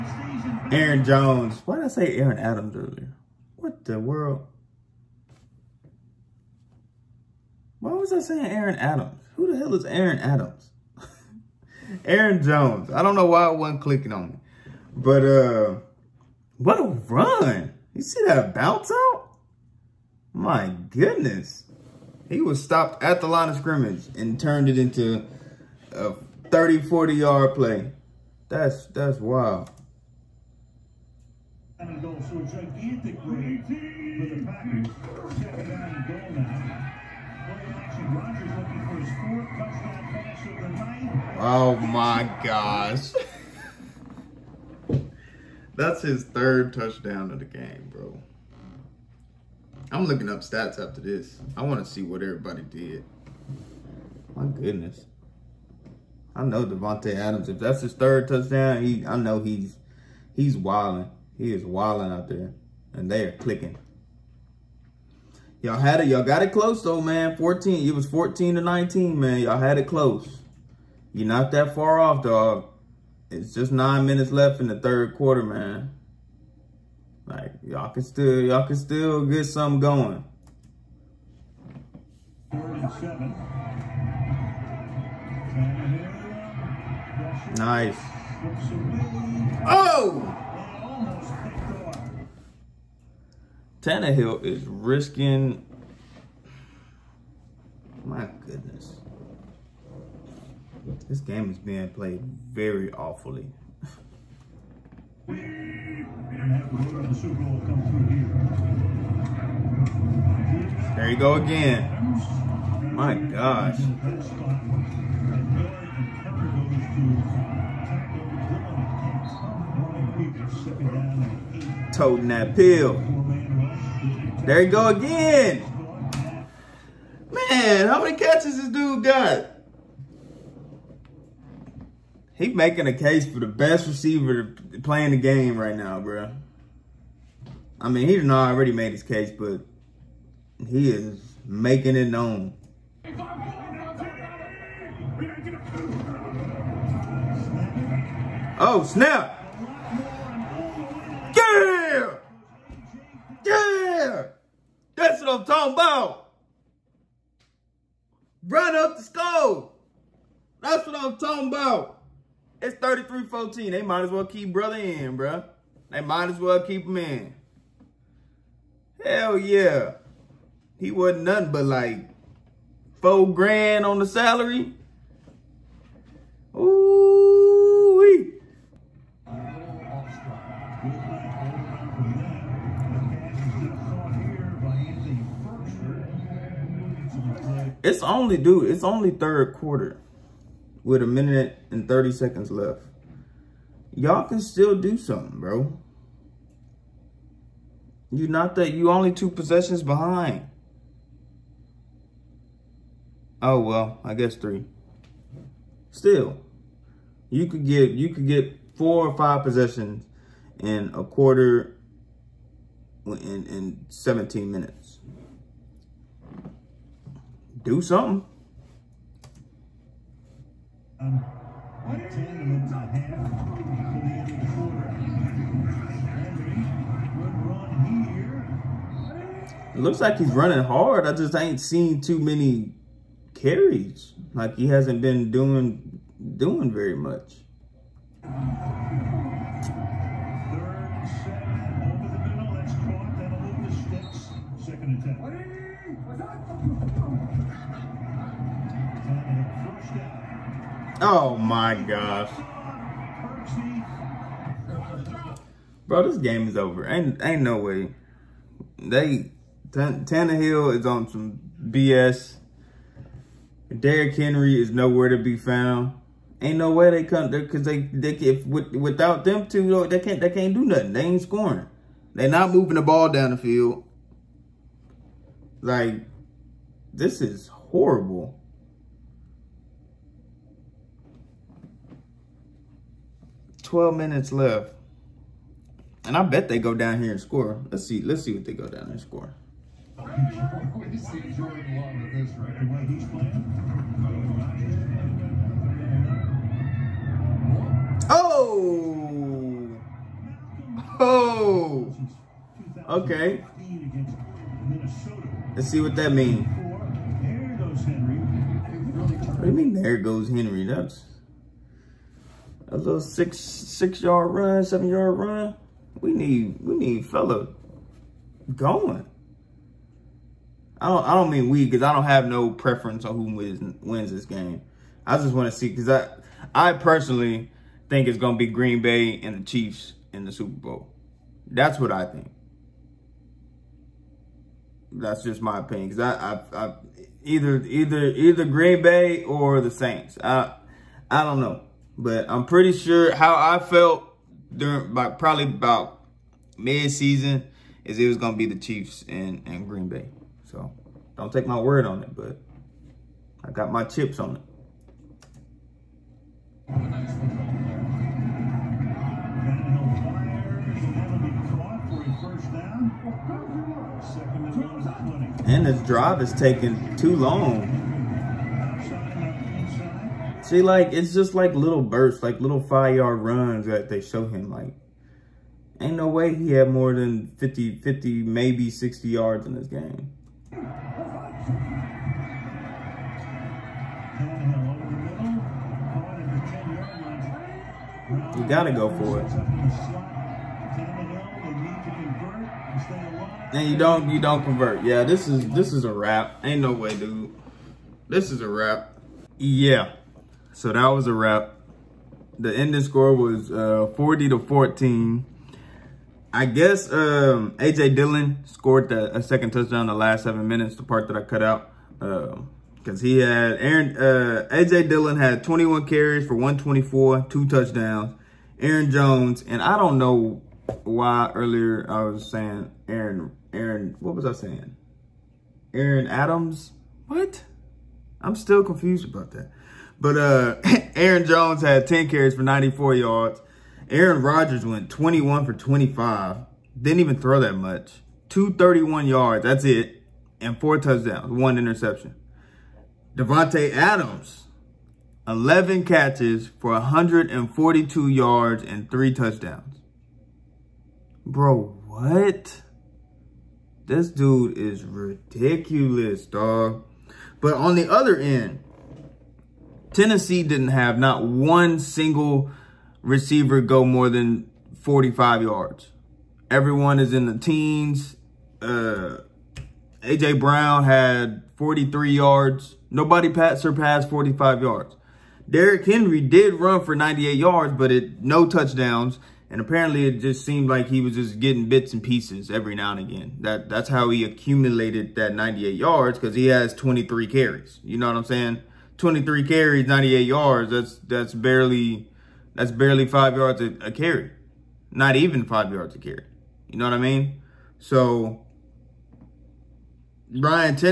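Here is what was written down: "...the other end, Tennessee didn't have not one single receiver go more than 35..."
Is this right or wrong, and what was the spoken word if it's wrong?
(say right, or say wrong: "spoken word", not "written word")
wrong: "45", not "35".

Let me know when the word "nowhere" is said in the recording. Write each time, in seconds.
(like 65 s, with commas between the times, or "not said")
264 s.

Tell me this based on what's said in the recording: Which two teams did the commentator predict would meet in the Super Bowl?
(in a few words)
Green Bay and the Chiefs.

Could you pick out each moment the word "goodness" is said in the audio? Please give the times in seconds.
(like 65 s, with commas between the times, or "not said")
20 s, 54 s, 98 s.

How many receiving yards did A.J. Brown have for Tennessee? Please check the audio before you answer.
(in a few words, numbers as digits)
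43.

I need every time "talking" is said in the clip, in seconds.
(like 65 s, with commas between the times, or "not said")
155 s, 161 s.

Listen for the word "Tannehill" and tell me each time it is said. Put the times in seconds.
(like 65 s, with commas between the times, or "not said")
93 s, 259 s.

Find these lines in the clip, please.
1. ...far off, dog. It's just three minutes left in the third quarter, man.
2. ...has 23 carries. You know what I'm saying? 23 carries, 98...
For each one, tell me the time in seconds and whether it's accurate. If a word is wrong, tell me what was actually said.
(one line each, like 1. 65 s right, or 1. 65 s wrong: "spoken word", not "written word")
1. 71 s wrong: "nine", not "three"
2. 486 s right.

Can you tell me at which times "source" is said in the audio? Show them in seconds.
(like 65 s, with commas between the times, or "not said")
not said.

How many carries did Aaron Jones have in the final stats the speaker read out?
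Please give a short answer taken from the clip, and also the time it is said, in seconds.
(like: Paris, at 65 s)
10, at 431 s.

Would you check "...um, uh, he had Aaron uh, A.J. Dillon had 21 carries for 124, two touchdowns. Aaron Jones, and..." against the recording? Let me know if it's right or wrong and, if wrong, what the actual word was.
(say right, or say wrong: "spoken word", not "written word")
right.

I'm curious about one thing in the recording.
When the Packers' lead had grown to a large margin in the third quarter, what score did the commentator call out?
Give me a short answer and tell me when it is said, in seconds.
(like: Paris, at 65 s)
33-14, at 162 s.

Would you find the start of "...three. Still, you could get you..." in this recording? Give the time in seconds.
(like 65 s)
204 s.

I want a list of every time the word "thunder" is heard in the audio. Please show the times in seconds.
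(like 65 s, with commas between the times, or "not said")
not said.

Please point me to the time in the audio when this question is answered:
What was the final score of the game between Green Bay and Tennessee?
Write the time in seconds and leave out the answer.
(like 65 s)
403 s.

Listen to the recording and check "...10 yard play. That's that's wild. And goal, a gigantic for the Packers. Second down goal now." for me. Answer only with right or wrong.
wrong.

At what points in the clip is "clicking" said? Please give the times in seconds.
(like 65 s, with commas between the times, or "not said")
13 s, 63 s.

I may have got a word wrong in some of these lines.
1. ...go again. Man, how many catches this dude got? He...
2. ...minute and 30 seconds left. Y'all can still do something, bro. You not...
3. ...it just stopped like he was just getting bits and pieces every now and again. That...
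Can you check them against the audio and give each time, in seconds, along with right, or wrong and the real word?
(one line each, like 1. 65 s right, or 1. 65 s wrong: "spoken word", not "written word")
1. 124 s right
2. 191 s right
3. 480 s wrong: "seemed", not "stopped".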